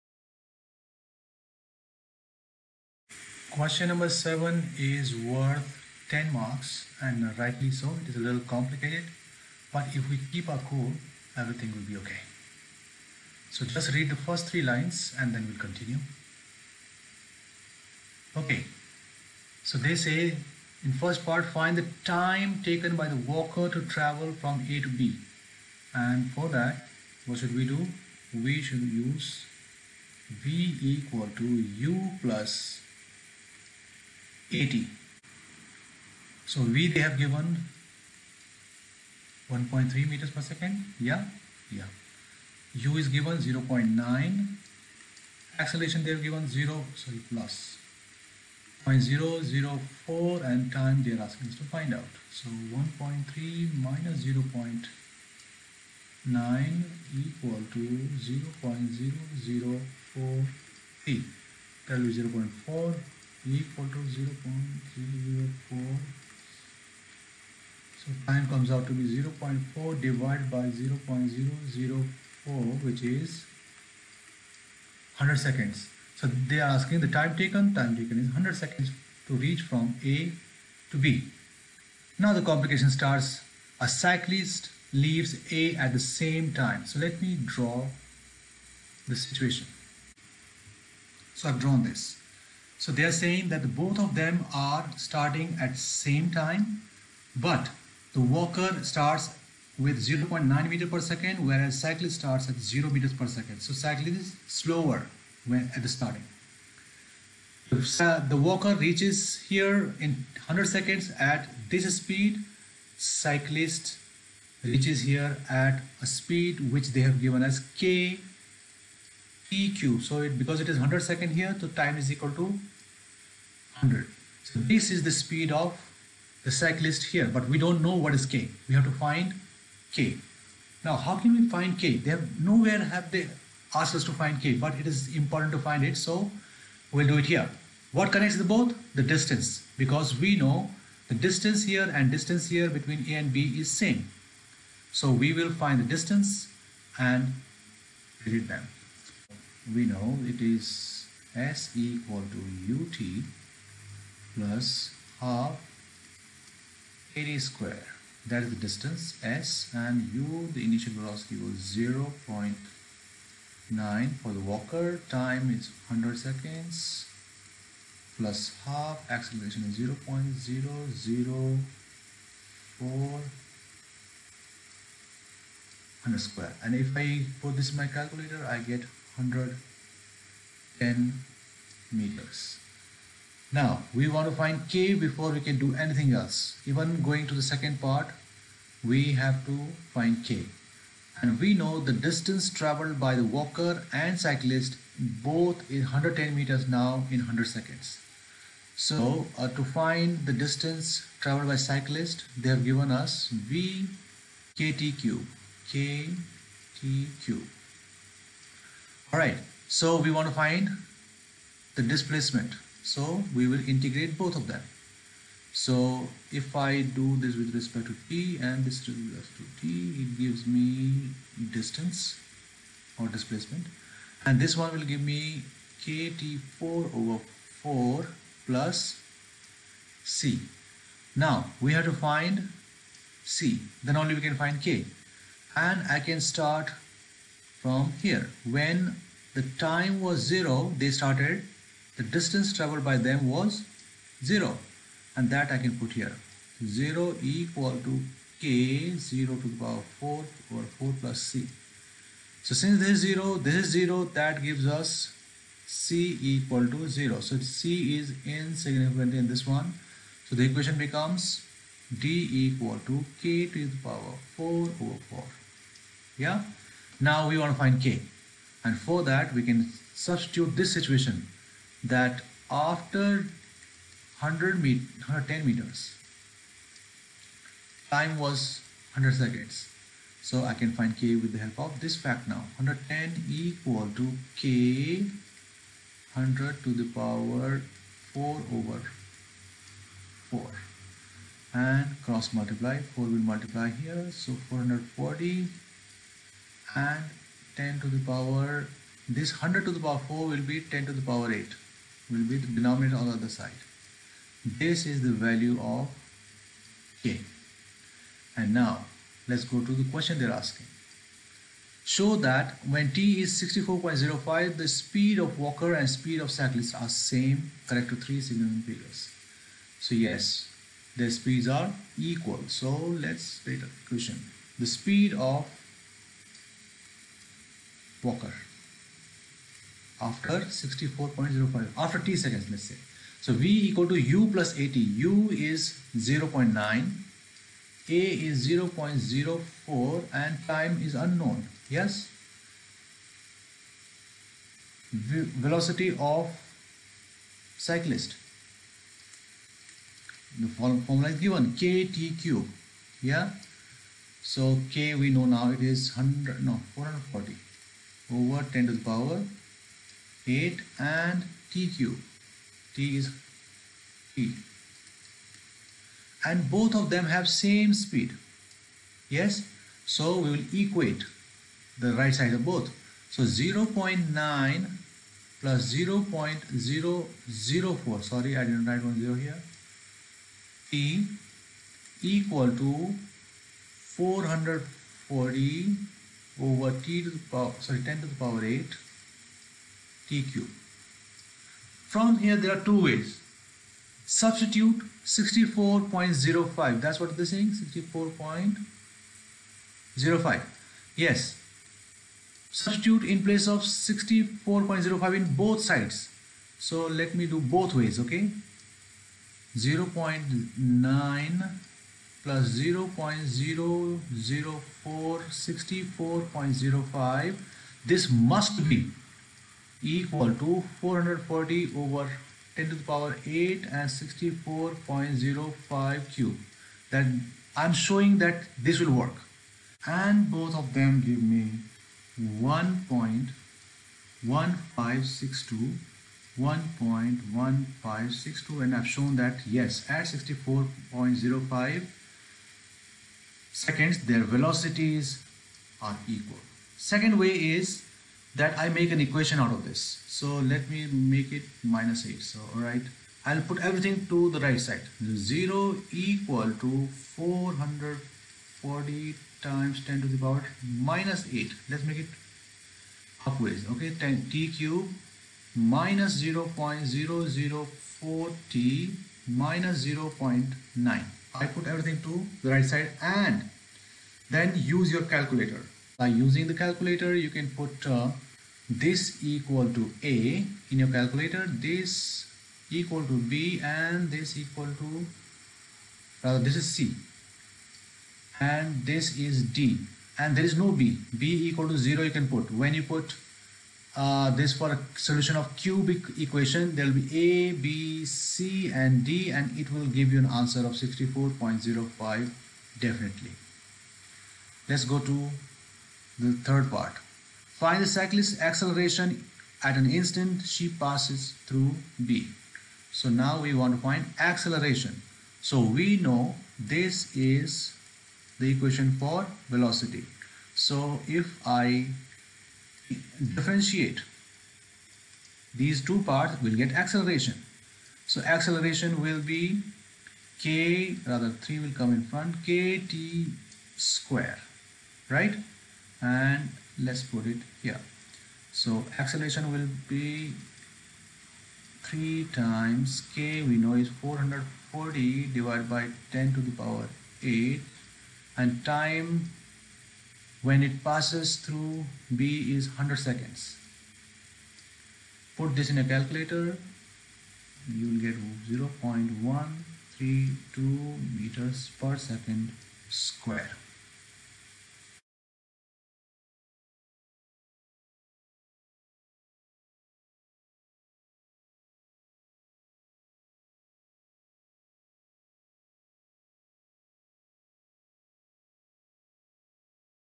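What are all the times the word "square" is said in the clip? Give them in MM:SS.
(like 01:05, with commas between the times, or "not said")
02:37, 02:56, 08:53, 09:22.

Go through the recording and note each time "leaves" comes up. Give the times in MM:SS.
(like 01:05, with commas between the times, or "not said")
01:24.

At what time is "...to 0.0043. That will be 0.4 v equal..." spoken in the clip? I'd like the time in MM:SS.
00:57.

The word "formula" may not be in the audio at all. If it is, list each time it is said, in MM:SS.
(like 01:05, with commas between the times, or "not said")
05:50.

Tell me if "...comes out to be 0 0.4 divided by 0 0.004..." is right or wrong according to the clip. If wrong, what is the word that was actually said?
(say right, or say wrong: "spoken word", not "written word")
right.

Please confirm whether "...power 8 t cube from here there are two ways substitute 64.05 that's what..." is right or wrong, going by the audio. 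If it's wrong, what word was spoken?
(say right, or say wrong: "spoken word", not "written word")
right.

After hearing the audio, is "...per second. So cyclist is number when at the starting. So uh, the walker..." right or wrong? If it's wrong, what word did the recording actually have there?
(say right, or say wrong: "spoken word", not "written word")
wrong: "slower", not "number".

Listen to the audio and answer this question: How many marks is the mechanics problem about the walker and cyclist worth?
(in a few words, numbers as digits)
10.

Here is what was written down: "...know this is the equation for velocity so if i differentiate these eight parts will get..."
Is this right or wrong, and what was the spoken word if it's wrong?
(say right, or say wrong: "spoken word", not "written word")
wrong: "two", not "eight".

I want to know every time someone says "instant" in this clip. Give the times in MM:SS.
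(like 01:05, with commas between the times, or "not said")
08:29.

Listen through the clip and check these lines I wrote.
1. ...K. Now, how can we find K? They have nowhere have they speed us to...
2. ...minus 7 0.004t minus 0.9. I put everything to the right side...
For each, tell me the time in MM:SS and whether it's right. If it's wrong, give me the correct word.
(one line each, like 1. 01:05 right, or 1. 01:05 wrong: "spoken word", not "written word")
1. 02:09 wrong: "asked", not "speed"
2. 07:45 wrong: "0", not "7".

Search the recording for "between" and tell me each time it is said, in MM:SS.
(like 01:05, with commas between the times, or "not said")
02:22.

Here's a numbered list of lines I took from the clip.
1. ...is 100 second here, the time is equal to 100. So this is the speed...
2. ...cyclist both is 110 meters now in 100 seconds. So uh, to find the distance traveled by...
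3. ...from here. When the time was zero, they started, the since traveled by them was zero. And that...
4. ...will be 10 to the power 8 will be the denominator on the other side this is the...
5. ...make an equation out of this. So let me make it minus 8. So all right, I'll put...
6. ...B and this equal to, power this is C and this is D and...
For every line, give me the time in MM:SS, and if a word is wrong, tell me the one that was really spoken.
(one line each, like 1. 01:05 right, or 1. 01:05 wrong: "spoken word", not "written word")
1. 02:00 right
2. 03:14 right
3. 03:57 wrong: "distance", not "since"
4. 05:00 right
5. 07:28 right
6. 08:03 wrong: "rather", not "power".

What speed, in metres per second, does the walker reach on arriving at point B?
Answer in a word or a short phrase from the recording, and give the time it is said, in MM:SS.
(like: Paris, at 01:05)
1.3, at 00:39.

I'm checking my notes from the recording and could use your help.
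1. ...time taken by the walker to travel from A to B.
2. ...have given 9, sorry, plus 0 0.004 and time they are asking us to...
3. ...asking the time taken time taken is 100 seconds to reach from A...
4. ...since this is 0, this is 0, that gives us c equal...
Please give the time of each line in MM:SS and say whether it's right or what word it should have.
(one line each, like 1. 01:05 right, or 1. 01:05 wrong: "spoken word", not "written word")
1. 00:22 right
2. 00:46 wrong: "0", not "9"
3. 01:16 right
4. 04:12 right.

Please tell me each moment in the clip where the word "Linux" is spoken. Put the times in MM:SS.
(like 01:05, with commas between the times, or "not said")
not said.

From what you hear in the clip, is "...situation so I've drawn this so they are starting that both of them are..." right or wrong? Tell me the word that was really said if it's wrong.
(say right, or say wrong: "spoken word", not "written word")
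wrong: "saying", not "starting".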